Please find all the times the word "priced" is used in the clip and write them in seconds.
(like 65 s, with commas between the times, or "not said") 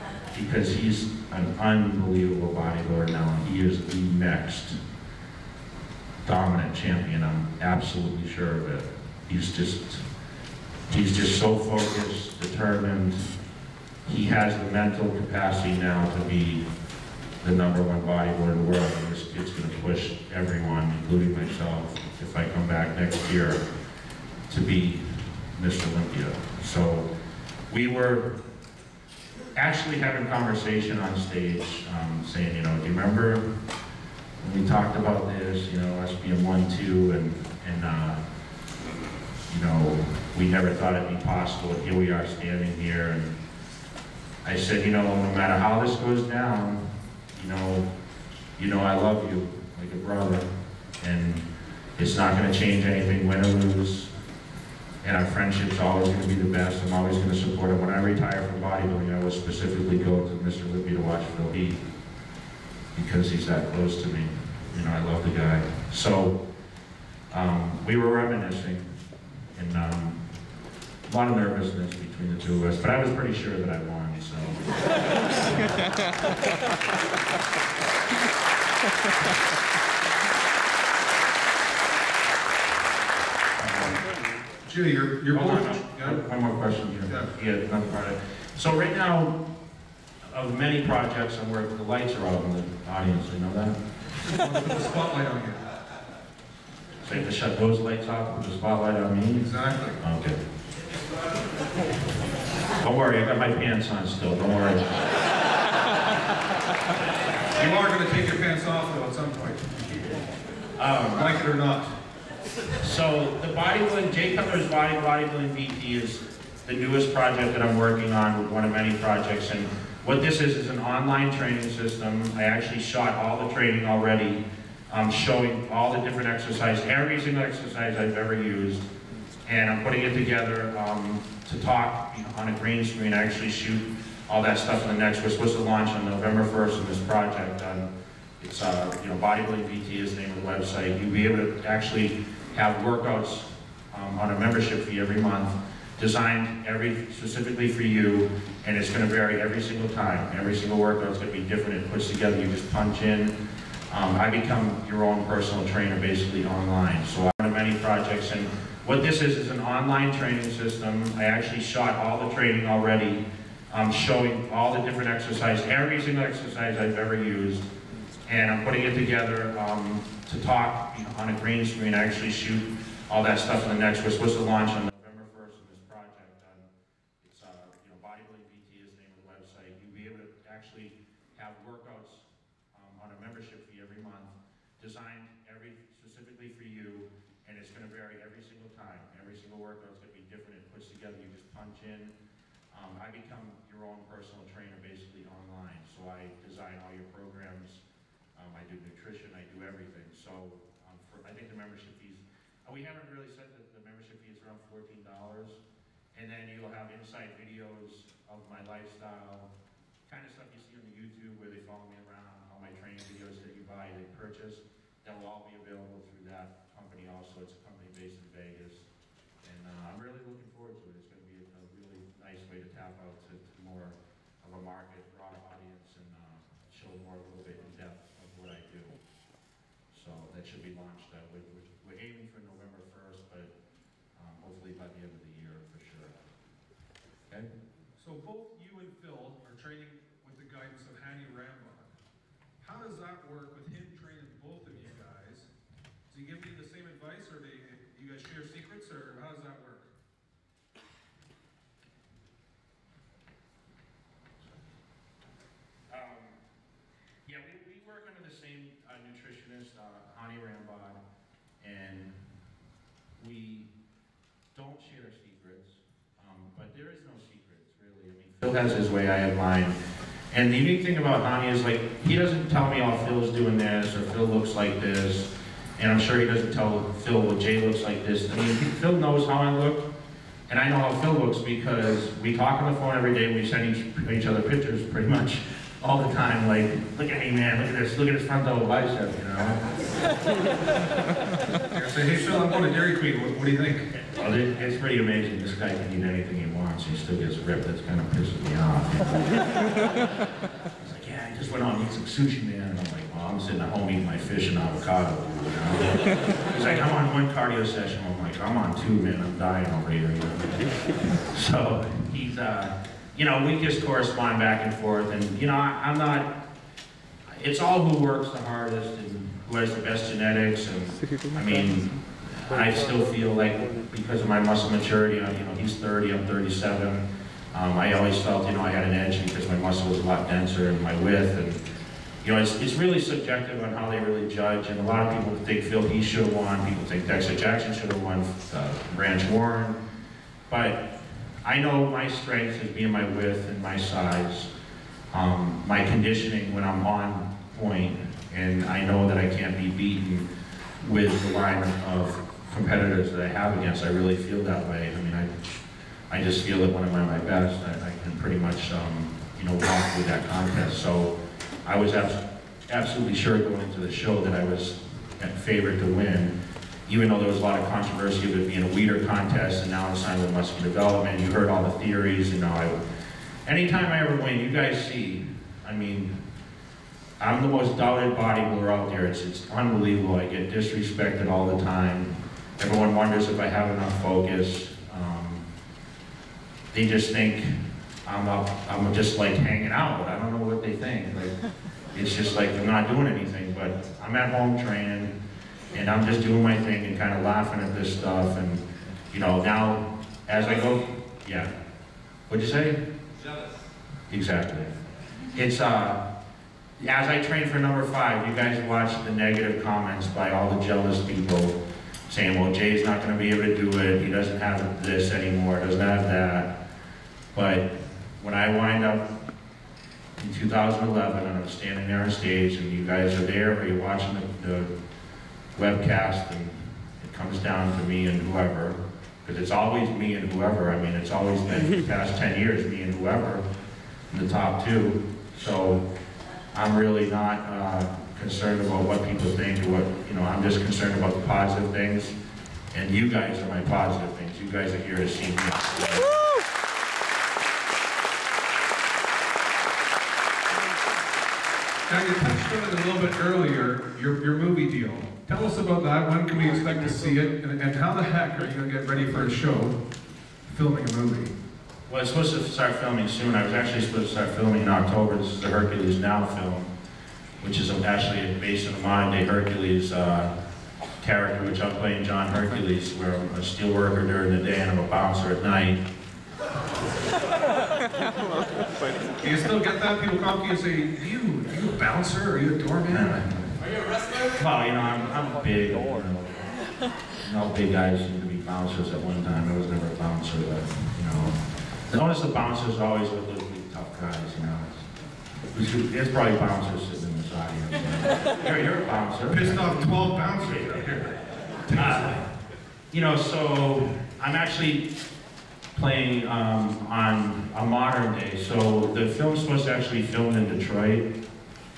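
not said.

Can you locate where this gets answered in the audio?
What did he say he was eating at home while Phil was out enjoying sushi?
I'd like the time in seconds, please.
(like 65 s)
304 s.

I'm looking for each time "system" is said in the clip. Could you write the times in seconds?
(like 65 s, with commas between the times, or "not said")
121 s, 160 s.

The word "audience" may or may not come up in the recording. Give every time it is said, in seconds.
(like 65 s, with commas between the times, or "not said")
92 s, 225 s.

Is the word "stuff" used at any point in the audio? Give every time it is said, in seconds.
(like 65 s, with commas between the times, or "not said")
134 s, 173 s, 210 s, 397 s.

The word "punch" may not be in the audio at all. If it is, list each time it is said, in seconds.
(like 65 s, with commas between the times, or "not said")
152 s, 191 s.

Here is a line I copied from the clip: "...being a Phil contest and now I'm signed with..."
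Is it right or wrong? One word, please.
wrong.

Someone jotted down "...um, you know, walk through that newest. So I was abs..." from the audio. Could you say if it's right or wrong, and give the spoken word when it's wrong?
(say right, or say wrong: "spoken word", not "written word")
wrong: "contest", not "newest".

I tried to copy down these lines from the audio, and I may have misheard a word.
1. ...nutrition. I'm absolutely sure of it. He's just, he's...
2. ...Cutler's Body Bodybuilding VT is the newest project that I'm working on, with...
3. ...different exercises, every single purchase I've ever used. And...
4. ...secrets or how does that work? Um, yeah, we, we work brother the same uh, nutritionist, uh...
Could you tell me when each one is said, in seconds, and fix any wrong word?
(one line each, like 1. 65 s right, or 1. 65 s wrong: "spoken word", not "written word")
1. 6 s wrong: "champion", not "nutrition"
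2. 114 s right
3. 164 s wrong: "exercise", not "purchase"
4. 248 s wrong: "under", not "brother".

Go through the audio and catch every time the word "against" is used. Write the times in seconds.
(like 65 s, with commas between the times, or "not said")
353 s.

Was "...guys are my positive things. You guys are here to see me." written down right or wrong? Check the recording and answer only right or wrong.
right.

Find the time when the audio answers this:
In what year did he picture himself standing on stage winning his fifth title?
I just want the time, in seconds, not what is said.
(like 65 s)
420 s.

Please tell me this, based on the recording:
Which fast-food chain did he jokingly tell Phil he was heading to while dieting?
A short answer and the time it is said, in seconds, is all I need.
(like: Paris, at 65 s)
Dairy Queen, at 292 s.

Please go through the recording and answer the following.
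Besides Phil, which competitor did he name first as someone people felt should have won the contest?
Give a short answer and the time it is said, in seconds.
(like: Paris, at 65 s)
Dexter Jackson, at 337 s.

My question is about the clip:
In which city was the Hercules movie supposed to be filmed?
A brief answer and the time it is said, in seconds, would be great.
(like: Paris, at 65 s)
Detroit, at 510 s.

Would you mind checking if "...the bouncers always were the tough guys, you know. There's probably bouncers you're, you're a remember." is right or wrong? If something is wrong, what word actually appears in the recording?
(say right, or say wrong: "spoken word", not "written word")
wrong: "bouncer", not "remember".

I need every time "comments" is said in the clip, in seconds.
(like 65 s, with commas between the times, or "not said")
409 s.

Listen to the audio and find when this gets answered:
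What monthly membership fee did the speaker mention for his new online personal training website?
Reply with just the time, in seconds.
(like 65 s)
204 s.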